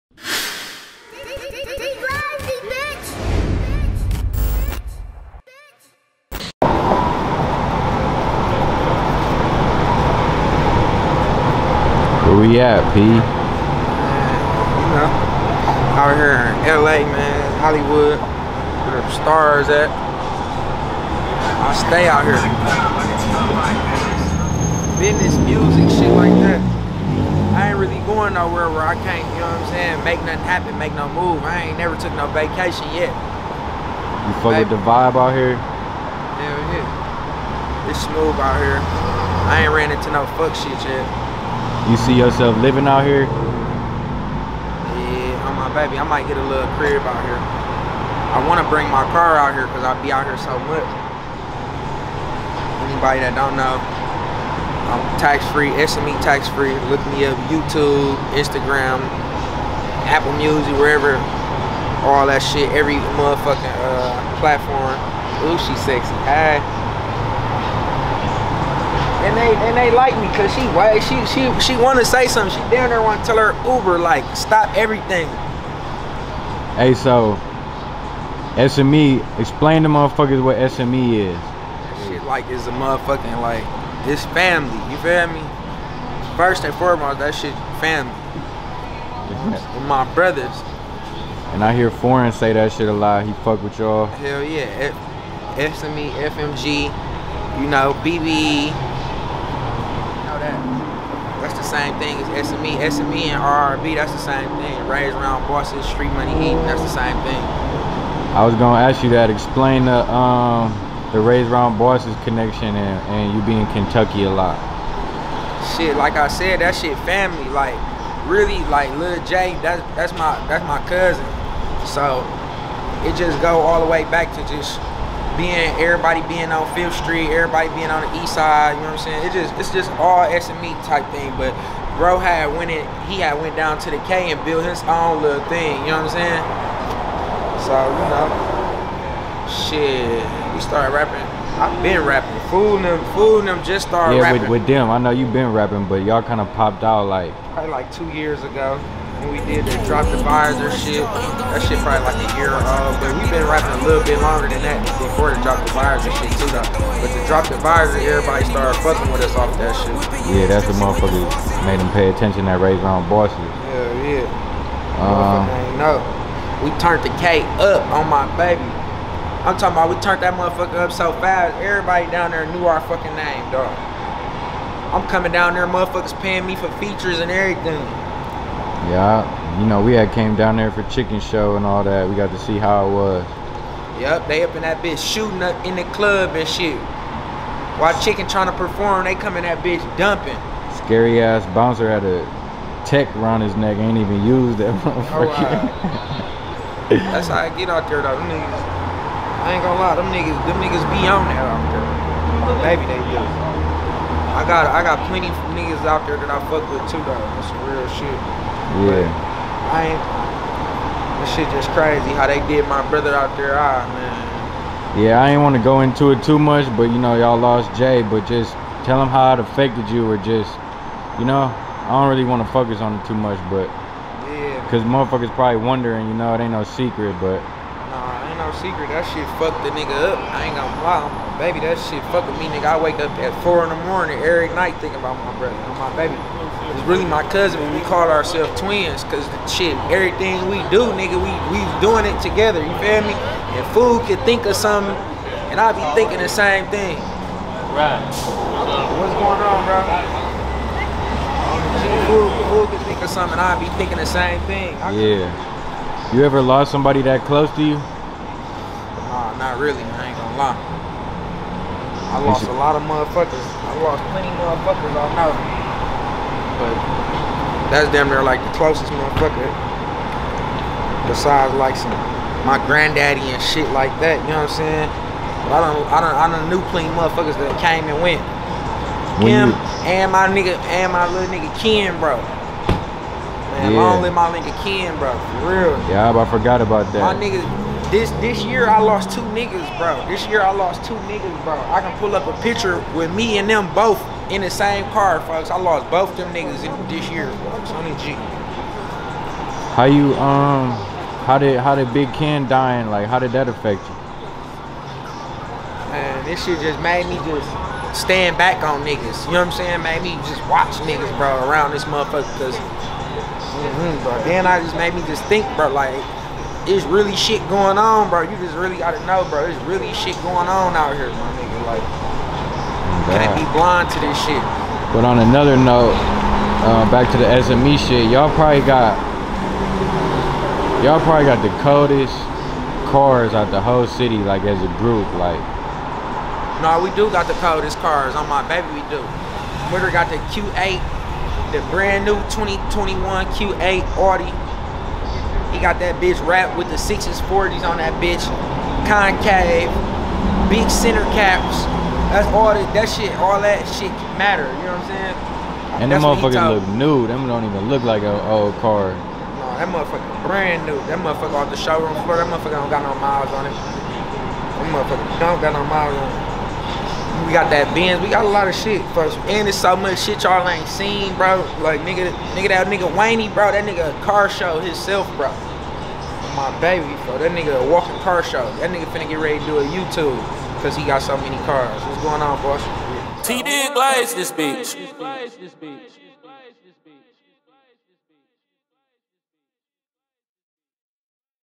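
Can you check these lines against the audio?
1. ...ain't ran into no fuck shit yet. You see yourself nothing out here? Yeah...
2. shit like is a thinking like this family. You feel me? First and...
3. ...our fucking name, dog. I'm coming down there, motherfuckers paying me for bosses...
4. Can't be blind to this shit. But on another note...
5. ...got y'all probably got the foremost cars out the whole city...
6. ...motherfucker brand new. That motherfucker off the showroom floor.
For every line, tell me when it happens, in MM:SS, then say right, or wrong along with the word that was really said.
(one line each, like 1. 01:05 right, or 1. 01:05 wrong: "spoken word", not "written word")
1. 00:39 wrong: "living", not "nothing"
2. 01:22 wrong: "motherfucking", not "thinking"
3. 02:52 wrong: "features", not "bosses"
4. 05:23 right
5. 05:28 wrong: "coldest", not "foremost"
6. 05:59 right.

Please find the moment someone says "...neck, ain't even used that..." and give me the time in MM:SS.
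03:13.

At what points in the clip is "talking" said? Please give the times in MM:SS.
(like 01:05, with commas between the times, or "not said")
02:49.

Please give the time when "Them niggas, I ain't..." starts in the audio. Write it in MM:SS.
03:18.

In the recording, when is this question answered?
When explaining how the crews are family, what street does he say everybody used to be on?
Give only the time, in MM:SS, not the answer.
02:06.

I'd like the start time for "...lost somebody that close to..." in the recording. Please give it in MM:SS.
04:16.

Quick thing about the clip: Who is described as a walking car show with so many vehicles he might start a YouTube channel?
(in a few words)
Wayne.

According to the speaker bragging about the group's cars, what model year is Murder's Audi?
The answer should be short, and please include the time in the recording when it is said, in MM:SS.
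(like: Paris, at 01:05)
2021, at 05:42.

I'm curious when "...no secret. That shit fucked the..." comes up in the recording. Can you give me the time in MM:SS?
03:48.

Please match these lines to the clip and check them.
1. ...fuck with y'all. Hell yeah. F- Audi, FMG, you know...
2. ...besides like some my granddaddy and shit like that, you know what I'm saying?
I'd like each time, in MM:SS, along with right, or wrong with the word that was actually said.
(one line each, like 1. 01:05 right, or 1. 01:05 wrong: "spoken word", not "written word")
1. 01:33 wrong: "SME", not "Audi"
2. 04:31 right.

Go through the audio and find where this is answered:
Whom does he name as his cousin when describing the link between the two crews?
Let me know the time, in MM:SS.
01:58.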